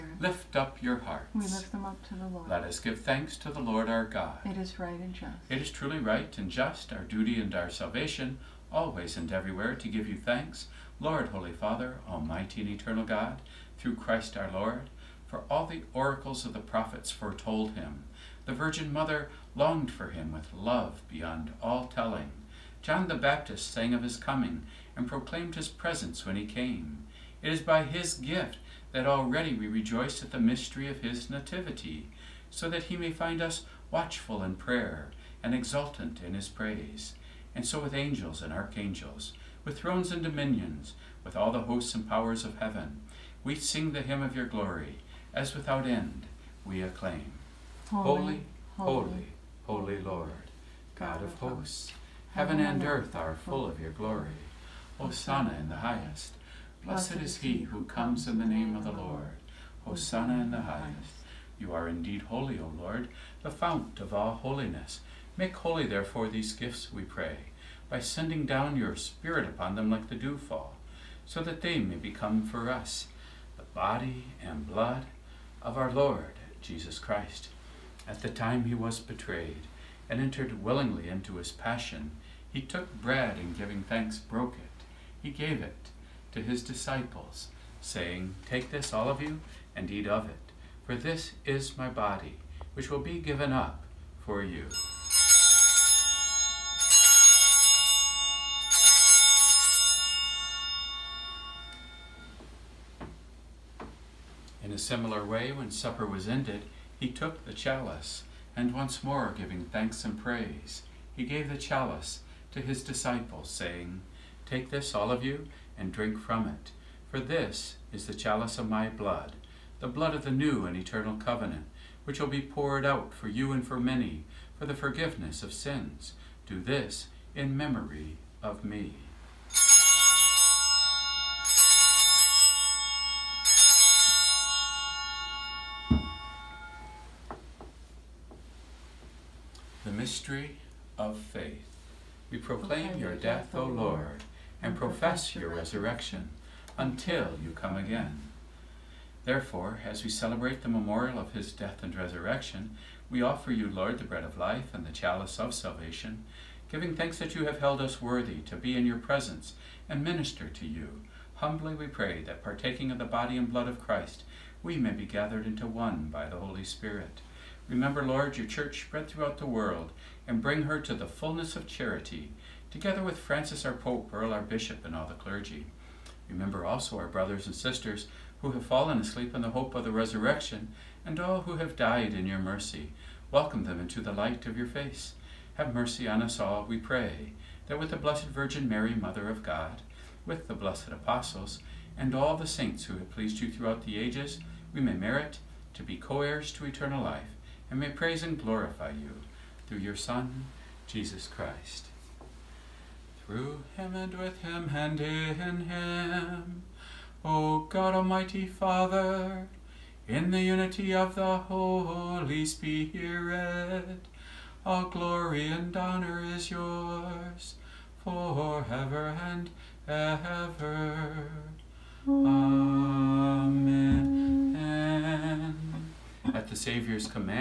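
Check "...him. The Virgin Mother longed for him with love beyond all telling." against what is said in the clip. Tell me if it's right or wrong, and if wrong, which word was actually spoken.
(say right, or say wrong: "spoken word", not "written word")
right.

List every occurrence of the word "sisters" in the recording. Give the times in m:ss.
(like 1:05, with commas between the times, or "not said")
2:57.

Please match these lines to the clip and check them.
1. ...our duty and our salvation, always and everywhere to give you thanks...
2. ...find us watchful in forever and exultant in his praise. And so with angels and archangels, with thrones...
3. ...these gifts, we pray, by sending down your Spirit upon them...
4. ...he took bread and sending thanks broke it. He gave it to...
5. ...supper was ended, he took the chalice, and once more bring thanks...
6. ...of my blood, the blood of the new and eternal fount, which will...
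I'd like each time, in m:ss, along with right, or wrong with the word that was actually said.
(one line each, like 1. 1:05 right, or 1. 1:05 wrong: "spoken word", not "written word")
1. 0:06 right
2. 0:33 wrong: "prayer", not "forever"
3. 1:06 right
4. 1:22 wrong: "giving", not "sending"
5. 1:45 wrong: "giving", not "bring"
6. 1:58 wrong: "covenant", not "fount".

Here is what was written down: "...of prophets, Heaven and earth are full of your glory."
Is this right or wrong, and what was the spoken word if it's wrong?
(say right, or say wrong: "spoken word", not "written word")
wrong: "hosts", not "prophets".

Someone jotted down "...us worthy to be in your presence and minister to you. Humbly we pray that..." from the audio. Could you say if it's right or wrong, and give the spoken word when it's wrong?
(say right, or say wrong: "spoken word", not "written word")
right.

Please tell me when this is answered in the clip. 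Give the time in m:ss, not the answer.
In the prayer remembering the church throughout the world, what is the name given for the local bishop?
2:54.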